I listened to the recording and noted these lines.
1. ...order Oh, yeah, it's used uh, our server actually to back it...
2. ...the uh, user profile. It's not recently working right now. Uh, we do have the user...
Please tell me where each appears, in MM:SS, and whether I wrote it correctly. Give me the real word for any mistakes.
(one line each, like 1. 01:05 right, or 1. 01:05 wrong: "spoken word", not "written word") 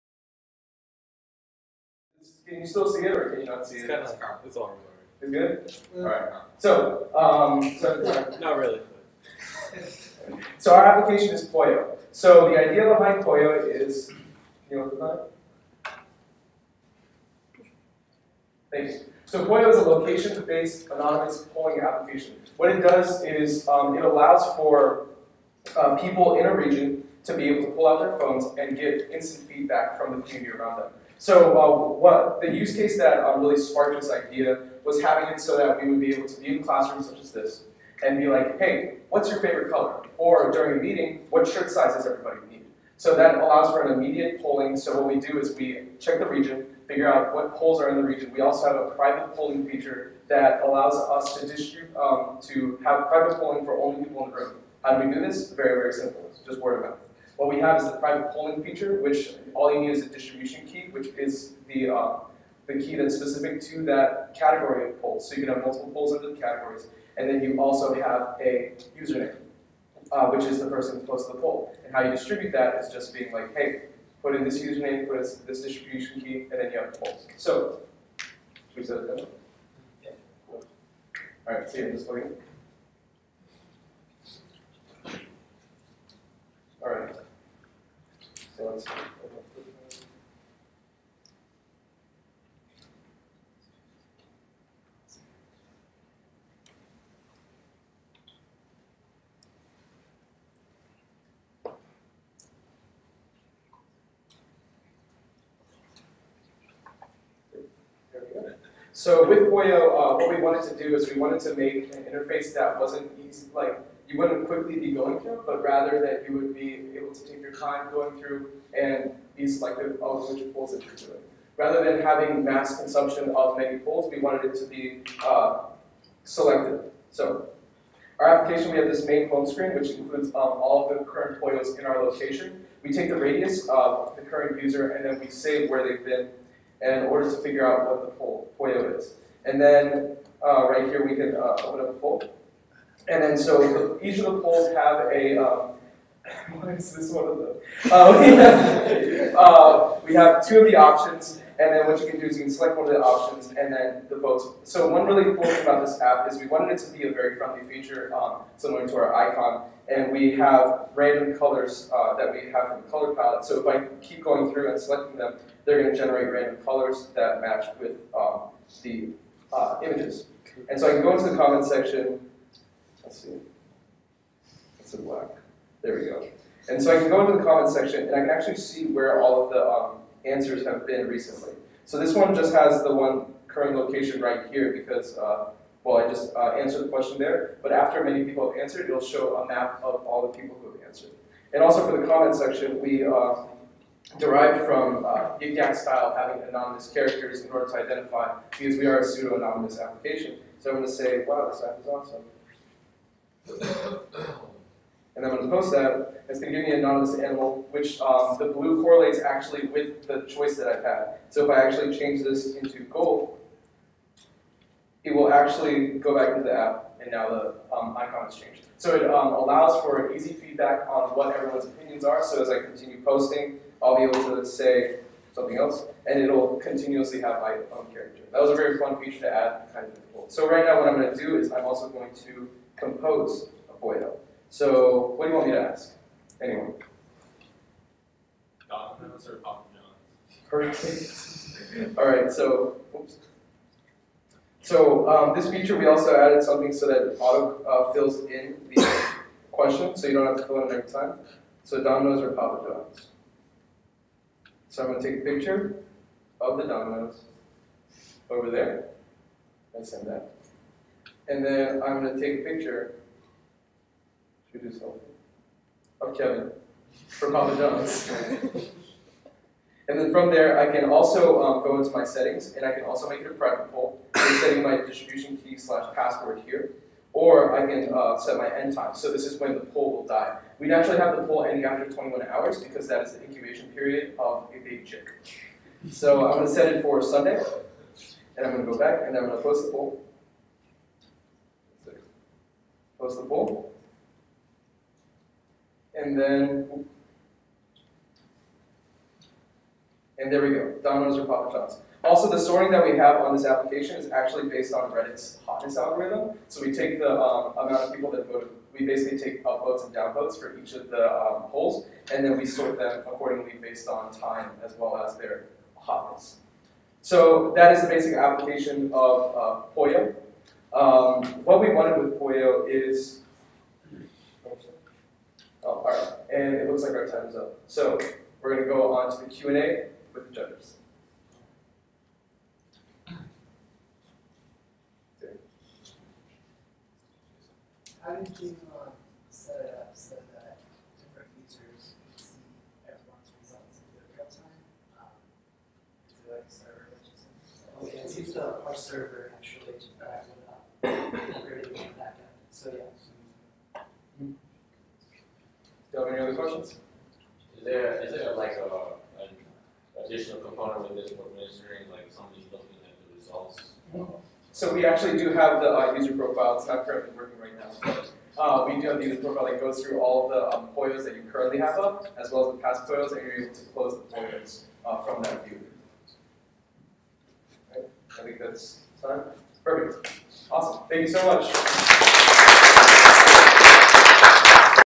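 1. 05:46 wrong: "server", not "order"
2. 06:05 wrong: "currently", not "recently".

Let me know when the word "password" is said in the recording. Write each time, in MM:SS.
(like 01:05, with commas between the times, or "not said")
04:35.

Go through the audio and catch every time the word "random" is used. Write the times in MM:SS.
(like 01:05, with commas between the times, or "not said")
02:40, 02:46.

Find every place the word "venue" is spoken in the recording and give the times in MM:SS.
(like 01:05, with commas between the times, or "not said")
not said.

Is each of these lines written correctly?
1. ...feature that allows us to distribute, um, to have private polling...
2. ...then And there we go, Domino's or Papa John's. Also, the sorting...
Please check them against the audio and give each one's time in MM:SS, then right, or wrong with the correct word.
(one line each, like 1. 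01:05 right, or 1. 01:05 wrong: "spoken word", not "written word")
1. 00:49 right
2. 04:56 right.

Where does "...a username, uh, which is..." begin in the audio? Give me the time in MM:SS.
01:08.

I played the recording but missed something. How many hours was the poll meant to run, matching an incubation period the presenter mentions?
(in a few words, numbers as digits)
21.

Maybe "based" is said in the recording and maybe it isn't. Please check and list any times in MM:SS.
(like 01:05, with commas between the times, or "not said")
00:19, 05:04, 05:13.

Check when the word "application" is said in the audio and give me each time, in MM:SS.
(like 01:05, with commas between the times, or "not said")
00:10, 00:21, 02:08, 03:19, 05:03, 05:18.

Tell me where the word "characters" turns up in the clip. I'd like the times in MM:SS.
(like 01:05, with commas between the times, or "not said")
03:16, 03:47.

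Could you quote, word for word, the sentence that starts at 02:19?
And then uh, right here, we can uh, open up a poll.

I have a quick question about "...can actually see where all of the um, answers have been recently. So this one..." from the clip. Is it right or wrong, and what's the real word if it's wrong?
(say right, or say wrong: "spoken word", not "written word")
right.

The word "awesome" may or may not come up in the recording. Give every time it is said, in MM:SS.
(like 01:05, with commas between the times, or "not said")
03:21, 06:20.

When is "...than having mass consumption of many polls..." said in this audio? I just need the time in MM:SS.
02:01.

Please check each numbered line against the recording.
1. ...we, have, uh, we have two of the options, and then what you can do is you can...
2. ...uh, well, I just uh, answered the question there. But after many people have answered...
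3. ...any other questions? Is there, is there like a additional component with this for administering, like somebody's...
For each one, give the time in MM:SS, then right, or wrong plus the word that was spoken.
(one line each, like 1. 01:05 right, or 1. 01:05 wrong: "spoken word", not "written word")
1. 02:28 right
2. 03:05 right
3. 05:56 right.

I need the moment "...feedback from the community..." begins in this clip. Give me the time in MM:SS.
00:29.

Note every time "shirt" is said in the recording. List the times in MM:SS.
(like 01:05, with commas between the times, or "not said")
00:41.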